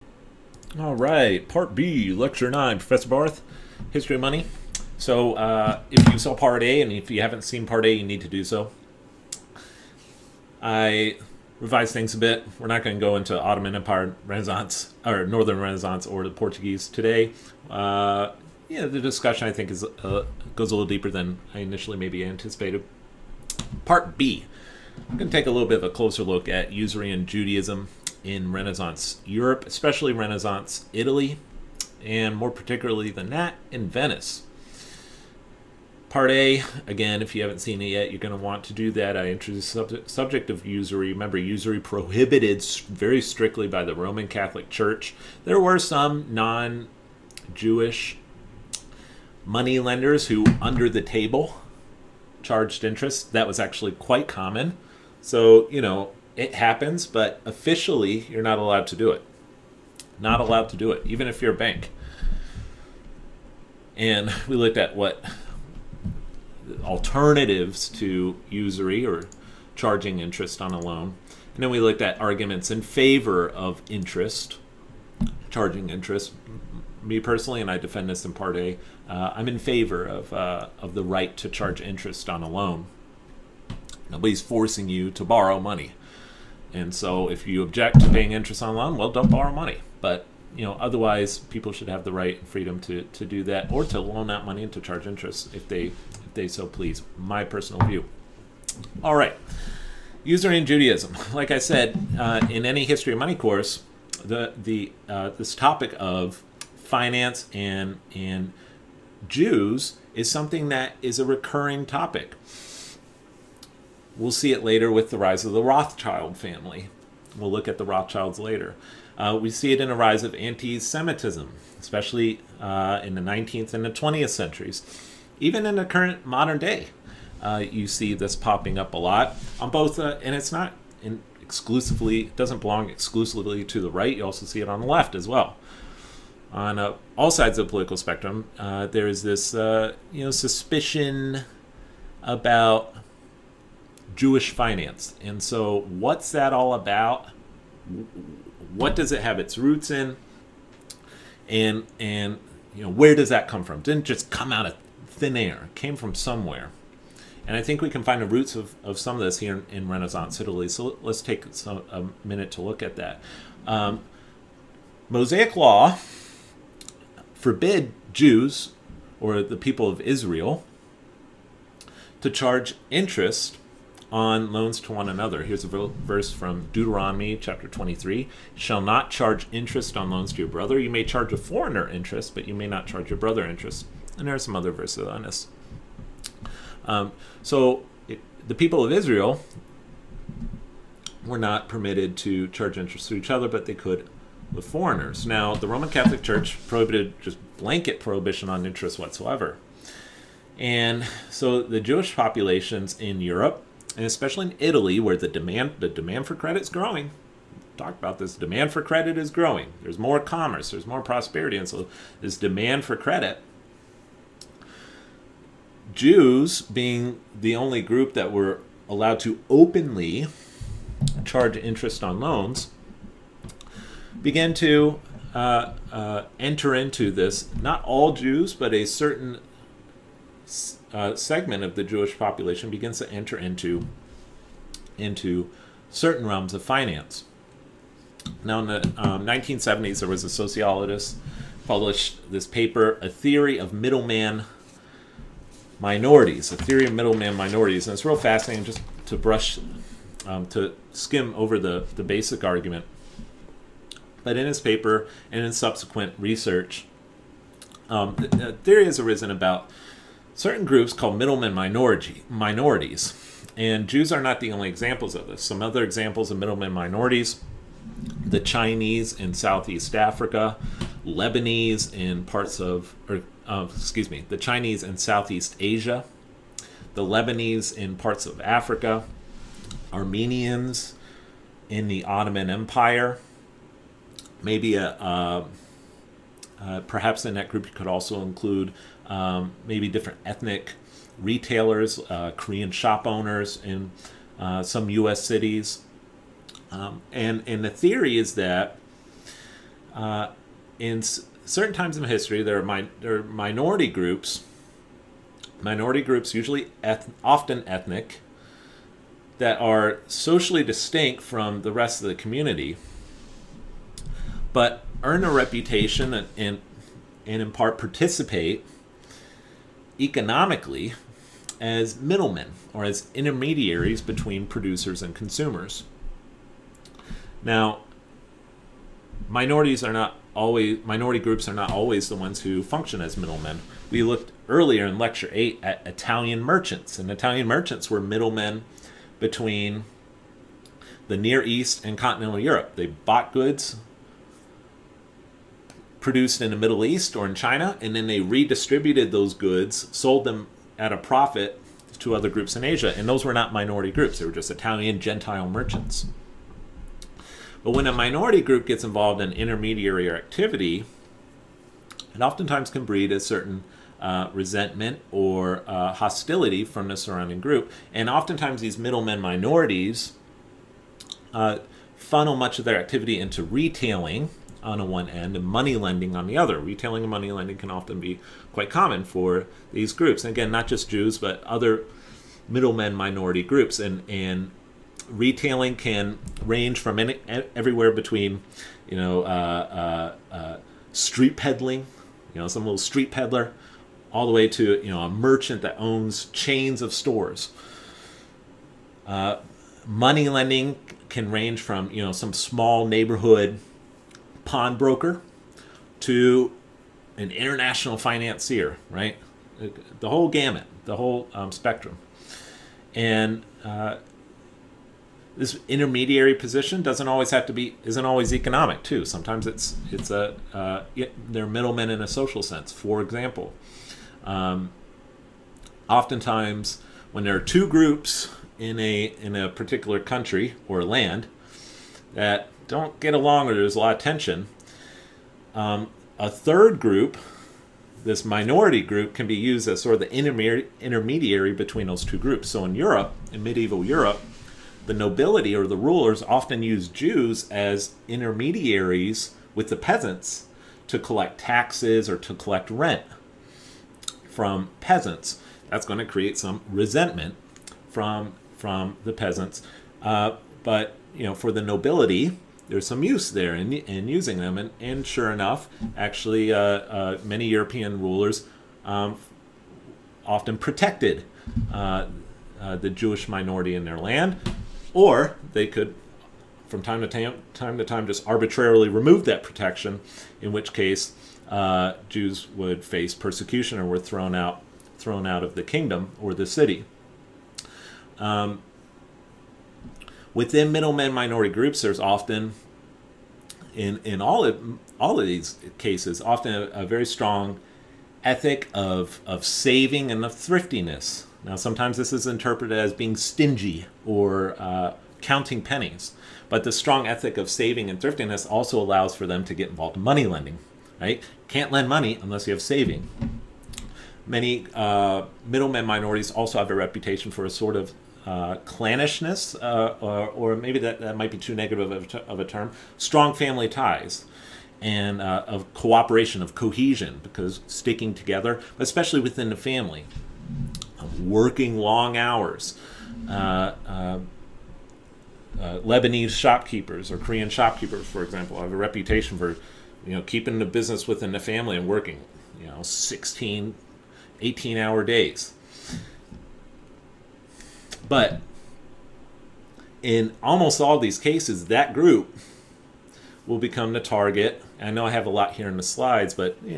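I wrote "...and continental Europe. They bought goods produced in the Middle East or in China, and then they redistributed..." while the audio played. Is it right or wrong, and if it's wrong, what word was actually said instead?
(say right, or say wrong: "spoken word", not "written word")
right.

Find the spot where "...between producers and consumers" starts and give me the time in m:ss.
5:24.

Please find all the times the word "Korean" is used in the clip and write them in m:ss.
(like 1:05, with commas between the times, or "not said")
4:52, 8:57.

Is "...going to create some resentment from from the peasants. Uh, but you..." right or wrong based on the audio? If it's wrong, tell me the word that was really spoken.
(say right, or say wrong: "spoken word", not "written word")
right.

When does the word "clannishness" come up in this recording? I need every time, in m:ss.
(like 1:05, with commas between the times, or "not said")
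8:38.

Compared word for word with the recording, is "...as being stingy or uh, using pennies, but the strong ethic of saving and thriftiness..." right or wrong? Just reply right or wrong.
wrong.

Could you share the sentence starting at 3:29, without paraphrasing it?
There's more commerce, there's more prosperity, and so this demand for credit.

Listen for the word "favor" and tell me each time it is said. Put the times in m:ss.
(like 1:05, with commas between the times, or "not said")
1:12, 1:19.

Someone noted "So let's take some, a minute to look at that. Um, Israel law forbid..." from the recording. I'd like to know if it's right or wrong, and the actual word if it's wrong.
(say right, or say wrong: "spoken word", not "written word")
wrong: "Mosaic", not "Israel".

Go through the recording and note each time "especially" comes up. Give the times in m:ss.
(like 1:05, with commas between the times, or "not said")
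0:29, 2:01, 3:24, 8:48.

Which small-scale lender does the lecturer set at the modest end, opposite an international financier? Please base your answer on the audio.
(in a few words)
neighborhood pawnbroker.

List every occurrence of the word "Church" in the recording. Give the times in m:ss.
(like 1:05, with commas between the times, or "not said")
0:44, 3:16.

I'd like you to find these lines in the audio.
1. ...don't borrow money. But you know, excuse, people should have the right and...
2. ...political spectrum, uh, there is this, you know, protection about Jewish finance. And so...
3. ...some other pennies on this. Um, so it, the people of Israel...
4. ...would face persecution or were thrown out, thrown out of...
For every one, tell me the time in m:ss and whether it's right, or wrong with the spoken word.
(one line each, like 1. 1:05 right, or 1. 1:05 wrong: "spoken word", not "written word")
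1. 1:29 wrong: "otherwise", not "excuse"
2. 2:17 wrong: "suspicion", not "protection"
3. 3:04 wrong: "verses", not "pennies"
4. 8:02 right.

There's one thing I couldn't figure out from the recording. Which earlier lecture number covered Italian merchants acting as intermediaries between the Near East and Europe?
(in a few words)
8.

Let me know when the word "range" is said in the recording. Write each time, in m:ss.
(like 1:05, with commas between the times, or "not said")
6:26, 6:41.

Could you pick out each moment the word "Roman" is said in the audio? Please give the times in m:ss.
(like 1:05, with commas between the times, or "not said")
0:43, 3:15.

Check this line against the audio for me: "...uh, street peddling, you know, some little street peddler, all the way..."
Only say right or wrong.
right.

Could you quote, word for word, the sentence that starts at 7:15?
Um, a third group, this minority group, can be used as sort of the intermediary between those two groups.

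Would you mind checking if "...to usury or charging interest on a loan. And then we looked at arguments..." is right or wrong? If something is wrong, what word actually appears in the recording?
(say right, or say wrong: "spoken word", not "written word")
right.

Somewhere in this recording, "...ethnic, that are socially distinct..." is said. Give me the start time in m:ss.
5:07.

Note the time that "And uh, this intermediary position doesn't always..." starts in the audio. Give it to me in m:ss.
6:52.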